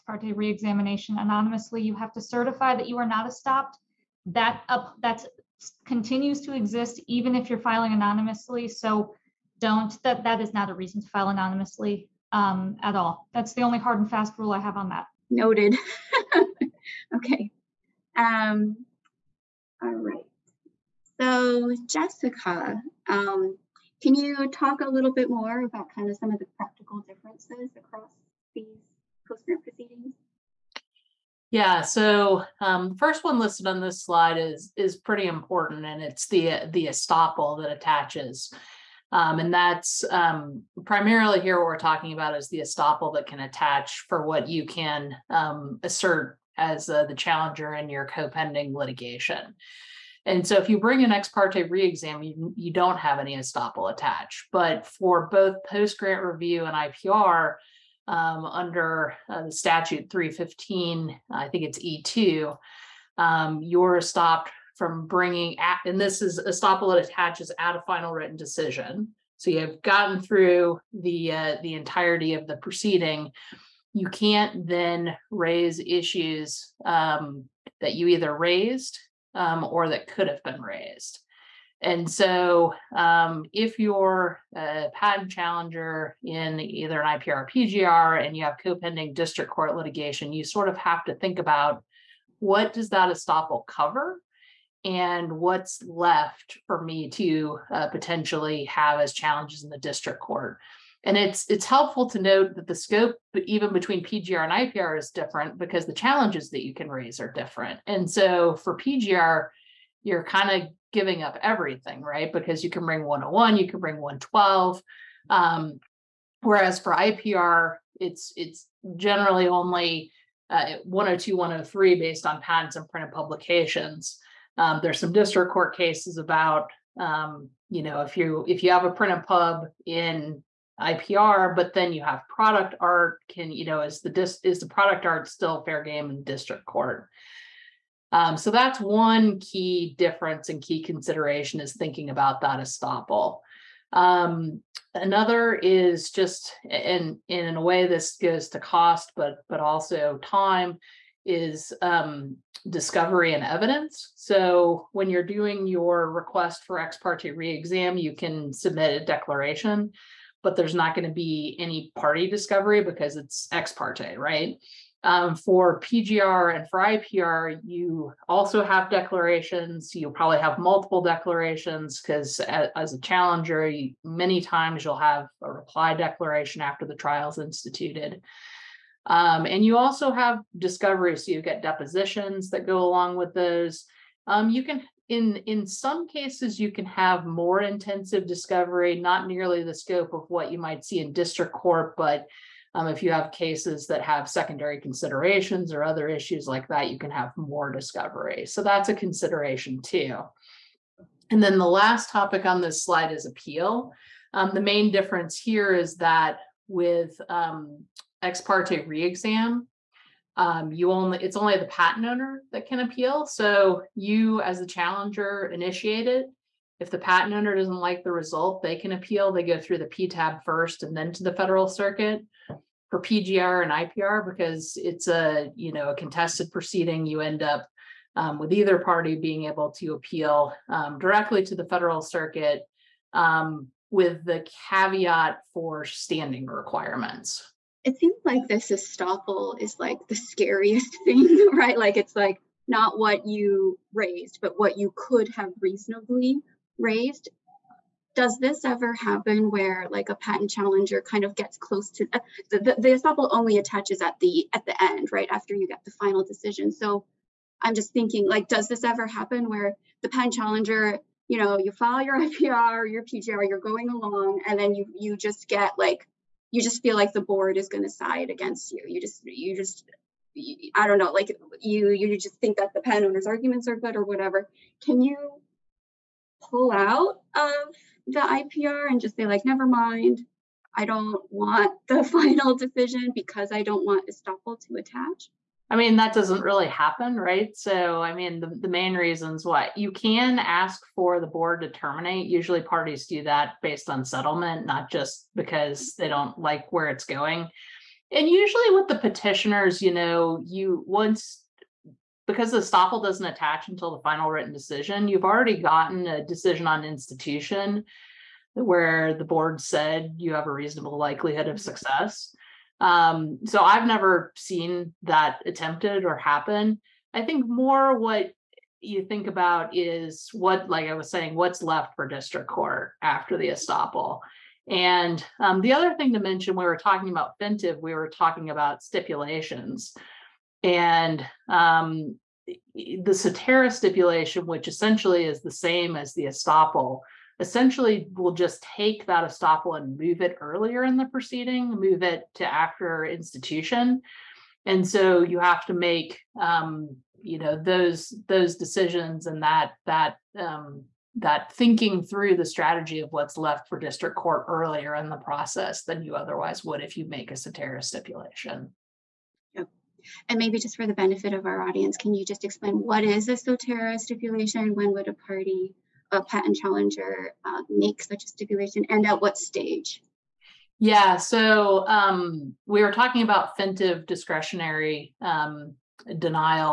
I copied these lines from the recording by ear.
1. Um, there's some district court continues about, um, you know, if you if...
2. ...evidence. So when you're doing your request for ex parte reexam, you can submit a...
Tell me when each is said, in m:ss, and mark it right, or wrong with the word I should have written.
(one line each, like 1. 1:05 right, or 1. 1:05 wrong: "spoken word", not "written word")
1. 2:04 wrong: "cases", not "continues"
2. 2:33 right.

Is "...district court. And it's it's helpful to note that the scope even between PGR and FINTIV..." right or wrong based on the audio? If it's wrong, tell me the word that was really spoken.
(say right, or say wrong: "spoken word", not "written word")
wrong: "IPR", not "FINTIV".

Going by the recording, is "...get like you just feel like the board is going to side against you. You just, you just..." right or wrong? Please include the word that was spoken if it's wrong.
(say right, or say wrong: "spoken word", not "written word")
right.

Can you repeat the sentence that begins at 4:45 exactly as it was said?
I mean, that doesn't really happen, right?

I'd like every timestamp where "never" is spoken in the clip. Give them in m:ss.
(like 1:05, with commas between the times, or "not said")
4:39, 5:13.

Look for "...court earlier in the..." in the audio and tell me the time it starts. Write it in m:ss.
5:54.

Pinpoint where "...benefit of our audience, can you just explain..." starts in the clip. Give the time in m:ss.
6:00.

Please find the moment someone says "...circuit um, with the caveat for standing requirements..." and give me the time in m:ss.
3:51.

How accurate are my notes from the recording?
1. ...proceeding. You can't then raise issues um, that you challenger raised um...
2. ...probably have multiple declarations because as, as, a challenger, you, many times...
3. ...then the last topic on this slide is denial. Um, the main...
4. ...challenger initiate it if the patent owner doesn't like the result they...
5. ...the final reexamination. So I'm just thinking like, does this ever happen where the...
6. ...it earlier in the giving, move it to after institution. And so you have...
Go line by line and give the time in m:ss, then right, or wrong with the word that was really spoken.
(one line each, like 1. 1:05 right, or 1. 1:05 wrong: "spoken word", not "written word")
1. 1:12 wrong: "either", not "challenger"
2. 2:50 right
3. 3:21 wrong: "appeal", not "denial"
4. 3:34 right
5. 4:15 wrong: "decision", not "reexamination"
6. 5:40 wrong: "proceeding", not "giving".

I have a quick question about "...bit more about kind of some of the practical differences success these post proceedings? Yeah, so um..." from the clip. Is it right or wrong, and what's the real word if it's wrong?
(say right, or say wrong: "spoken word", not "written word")
wrong: "across", not "success".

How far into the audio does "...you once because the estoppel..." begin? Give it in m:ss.
5:00.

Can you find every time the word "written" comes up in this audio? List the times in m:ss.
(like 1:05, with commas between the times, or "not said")
1:08, 5:04.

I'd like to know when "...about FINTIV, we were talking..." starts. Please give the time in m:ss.
5:27.